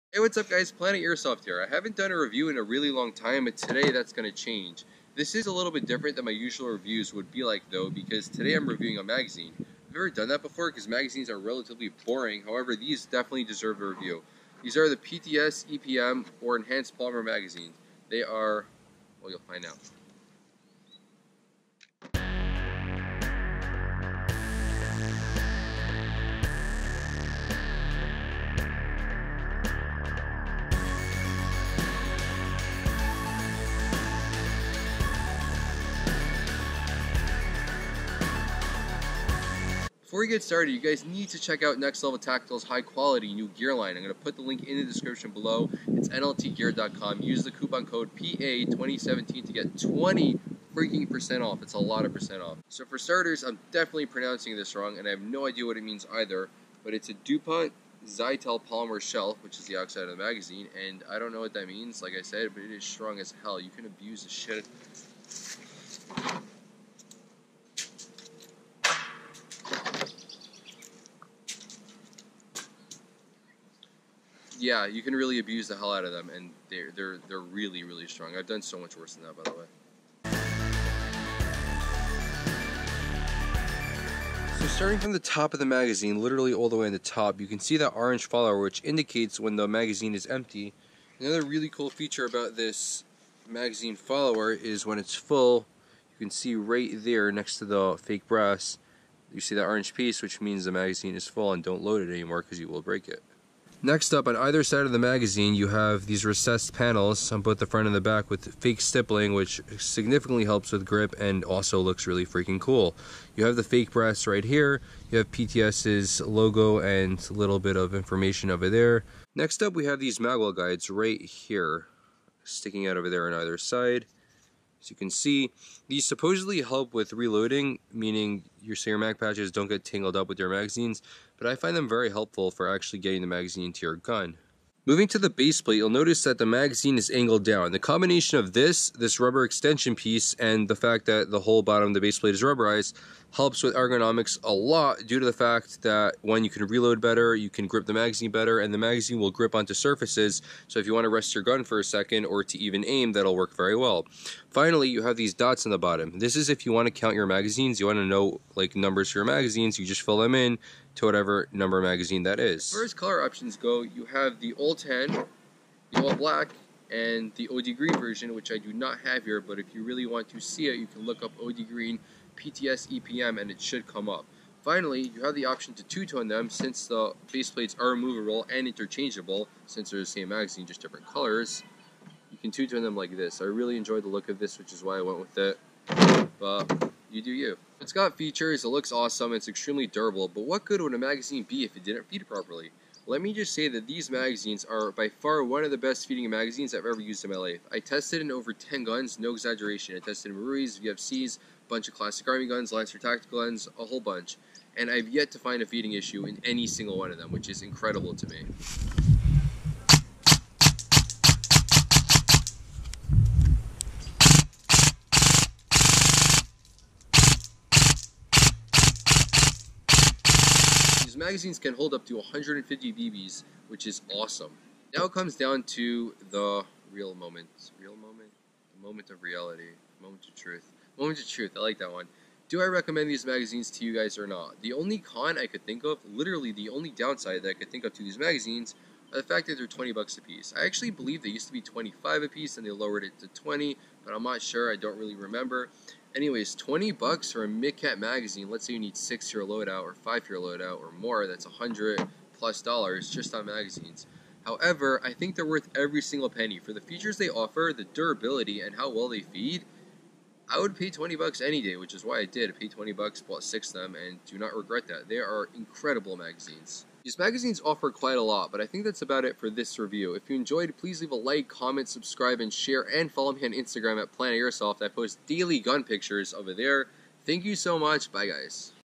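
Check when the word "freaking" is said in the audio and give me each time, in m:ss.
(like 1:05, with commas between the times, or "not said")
0:50, 1:52.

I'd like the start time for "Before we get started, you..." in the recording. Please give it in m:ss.
0:40.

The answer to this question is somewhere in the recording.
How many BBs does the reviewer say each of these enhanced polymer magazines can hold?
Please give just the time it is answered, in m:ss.
3:42.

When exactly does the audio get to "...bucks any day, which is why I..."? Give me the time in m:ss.
4:21.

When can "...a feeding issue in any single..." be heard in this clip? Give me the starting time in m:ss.
3:25.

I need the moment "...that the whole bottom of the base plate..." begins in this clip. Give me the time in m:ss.
2:21.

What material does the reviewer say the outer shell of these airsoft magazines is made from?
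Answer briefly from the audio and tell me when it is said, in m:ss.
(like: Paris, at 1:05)
DuPont Zytel polymer, at 0:57.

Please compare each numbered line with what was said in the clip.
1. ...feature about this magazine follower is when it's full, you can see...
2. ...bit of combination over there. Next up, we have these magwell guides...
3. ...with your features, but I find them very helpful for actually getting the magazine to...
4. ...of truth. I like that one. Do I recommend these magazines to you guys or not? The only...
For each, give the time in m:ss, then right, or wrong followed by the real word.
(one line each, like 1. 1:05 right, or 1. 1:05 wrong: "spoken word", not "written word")
1. 1:31 right
2. 1:57 wrong: "information", not "combination"
3. 2:10 wrong: "magazines", not "features"
4. 3:51 right.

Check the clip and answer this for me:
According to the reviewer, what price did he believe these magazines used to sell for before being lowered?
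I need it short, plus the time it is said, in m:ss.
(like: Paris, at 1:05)
$25, at 4:01.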